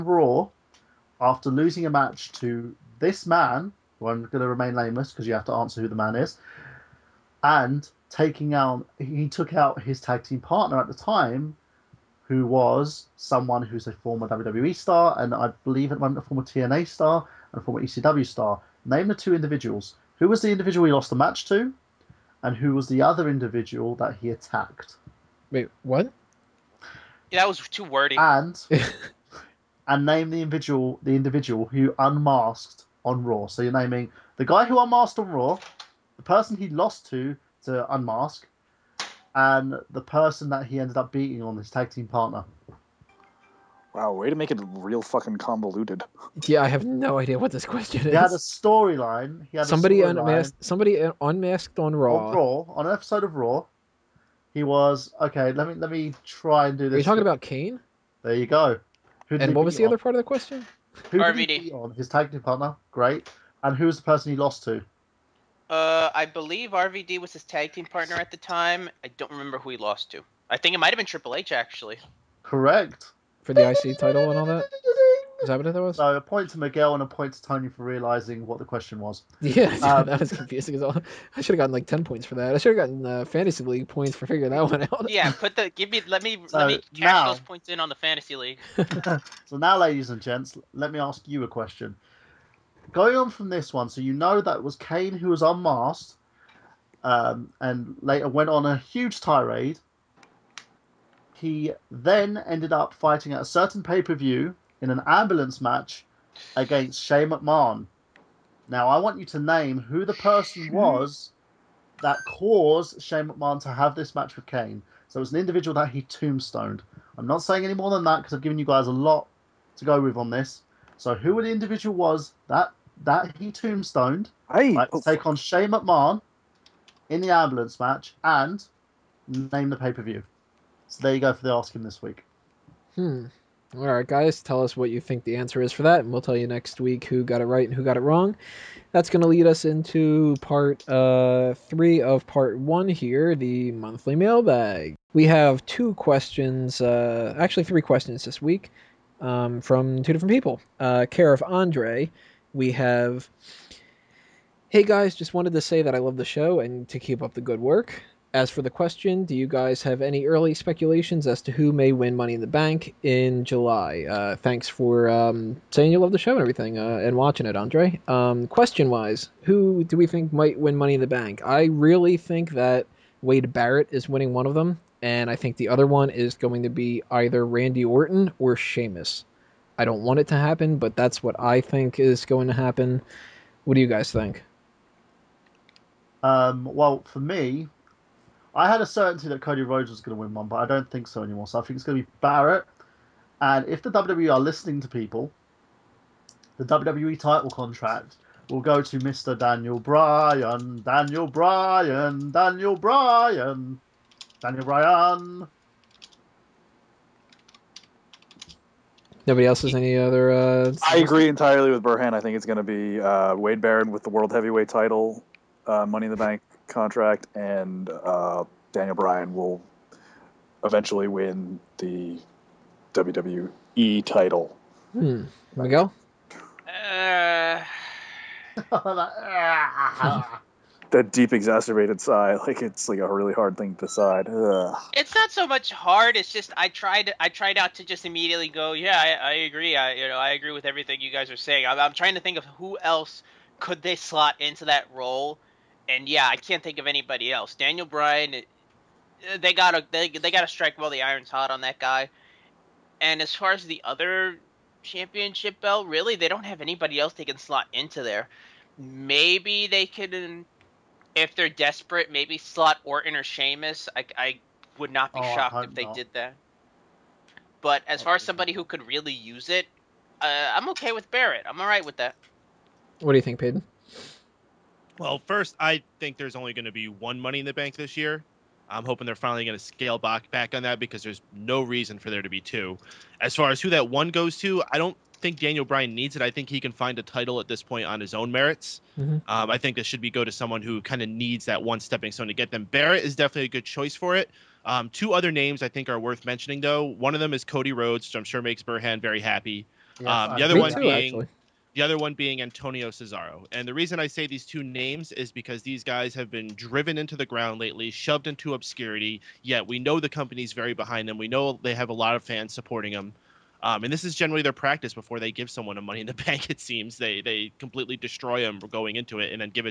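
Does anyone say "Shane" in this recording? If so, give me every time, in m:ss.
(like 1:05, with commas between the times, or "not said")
1:47, 1:53, 2:05.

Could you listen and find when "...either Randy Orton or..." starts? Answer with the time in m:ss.
2:57.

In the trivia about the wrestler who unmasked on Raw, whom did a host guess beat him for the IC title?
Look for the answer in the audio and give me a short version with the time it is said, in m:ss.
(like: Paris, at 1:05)
Triple H, at 1:11.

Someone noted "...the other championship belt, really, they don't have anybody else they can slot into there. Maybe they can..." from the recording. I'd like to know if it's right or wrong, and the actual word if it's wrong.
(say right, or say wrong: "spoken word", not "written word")
right.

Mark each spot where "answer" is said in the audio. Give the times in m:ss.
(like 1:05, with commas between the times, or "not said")
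0:05, 2:15.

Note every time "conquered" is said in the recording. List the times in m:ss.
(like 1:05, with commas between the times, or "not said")
not said.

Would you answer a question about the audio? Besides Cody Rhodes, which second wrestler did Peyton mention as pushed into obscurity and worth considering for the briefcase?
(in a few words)
Antonio Cesaro.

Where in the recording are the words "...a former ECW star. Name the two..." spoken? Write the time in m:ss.
0:17.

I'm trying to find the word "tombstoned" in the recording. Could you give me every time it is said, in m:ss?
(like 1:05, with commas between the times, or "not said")
1:56, 2:03.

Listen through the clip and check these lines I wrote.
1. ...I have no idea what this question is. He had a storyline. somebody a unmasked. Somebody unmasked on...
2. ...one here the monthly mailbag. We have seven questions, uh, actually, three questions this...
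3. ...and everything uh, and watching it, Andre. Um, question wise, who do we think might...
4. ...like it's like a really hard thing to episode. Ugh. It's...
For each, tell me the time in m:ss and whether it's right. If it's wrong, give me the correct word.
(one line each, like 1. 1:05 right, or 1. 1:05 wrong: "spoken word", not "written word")
1. 0:46 right
2. 2:22 wrong: "two", not "seven"
3. 2:46 right
4. 3:52 wrong: "decide", not "episode".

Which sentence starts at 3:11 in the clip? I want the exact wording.
So I think it's going to be Barrett.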